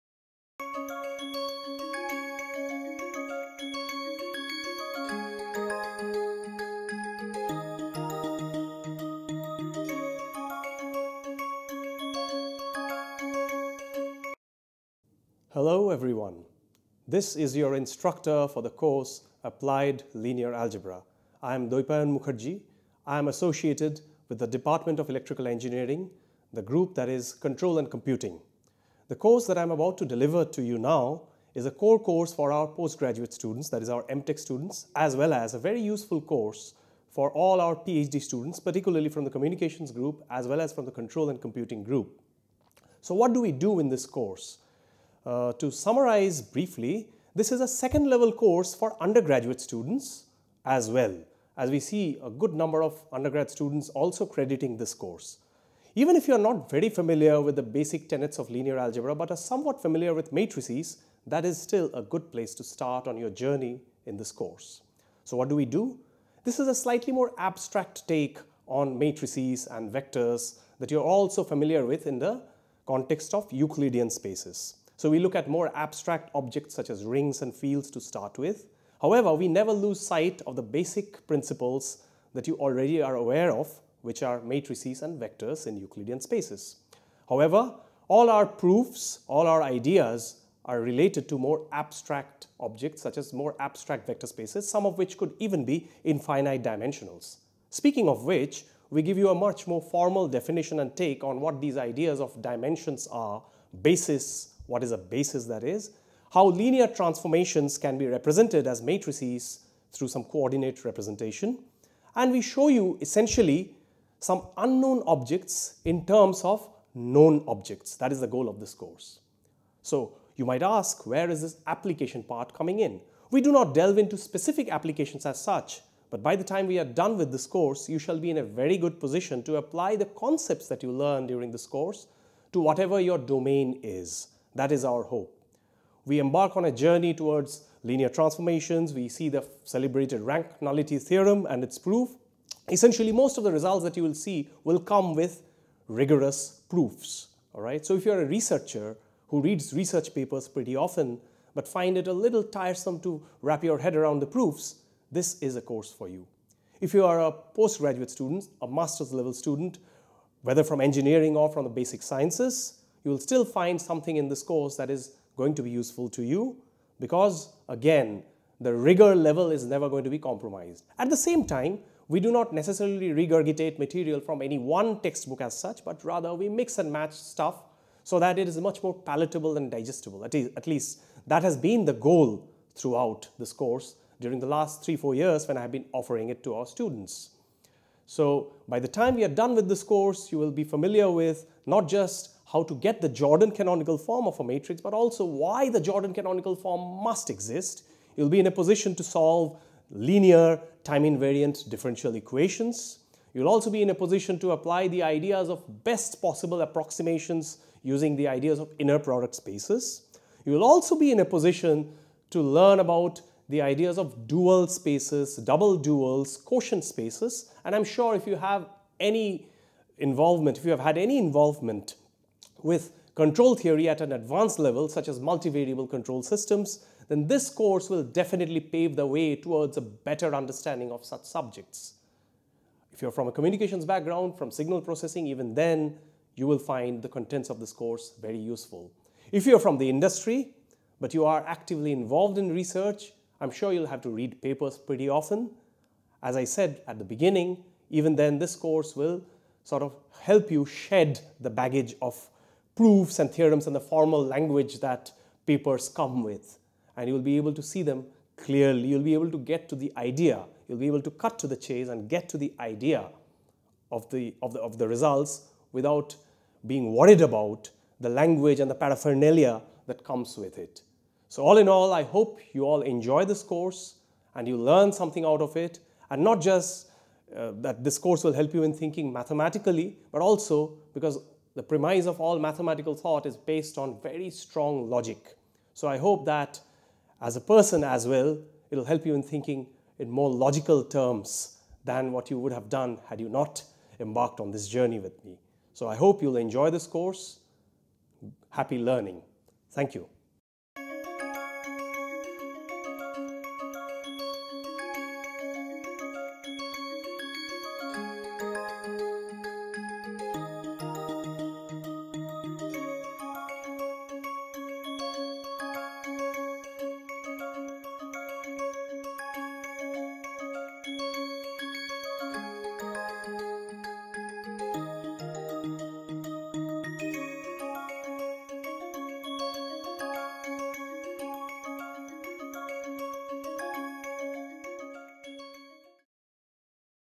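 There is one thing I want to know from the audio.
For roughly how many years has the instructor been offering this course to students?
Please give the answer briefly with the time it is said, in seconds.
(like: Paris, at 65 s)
3 to 4 years, at 184 s.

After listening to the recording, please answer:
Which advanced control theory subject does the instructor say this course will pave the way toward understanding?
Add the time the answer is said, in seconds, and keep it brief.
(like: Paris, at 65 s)
Multivariable control systems, at 225 s.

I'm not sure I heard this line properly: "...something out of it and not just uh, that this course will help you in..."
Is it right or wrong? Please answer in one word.
right.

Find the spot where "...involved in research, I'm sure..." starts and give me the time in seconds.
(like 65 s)
241 s.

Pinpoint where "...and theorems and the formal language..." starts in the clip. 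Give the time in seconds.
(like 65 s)
253 s.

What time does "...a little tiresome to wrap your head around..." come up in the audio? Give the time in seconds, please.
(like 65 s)
152 s.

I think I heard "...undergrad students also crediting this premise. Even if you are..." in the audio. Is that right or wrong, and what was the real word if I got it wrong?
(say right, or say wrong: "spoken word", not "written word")
wrong: "course", not "premise".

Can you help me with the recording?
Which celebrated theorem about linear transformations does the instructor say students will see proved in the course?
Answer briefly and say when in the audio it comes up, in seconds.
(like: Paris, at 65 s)
Rank nullity theorem, at 140 s.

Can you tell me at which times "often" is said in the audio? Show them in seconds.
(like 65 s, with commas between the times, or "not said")
150 s, 245 s.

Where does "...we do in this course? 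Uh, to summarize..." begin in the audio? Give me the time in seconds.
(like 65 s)
43 s.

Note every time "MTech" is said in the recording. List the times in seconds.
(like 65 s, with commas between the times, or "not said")
34 s.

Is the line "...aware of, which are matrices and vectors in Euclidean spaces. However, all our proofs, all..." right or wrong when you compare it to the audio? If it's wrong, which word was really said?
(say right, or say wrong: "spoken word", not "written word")
right.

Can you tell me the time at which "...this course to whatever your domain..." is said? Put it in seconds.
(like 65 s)
131 s.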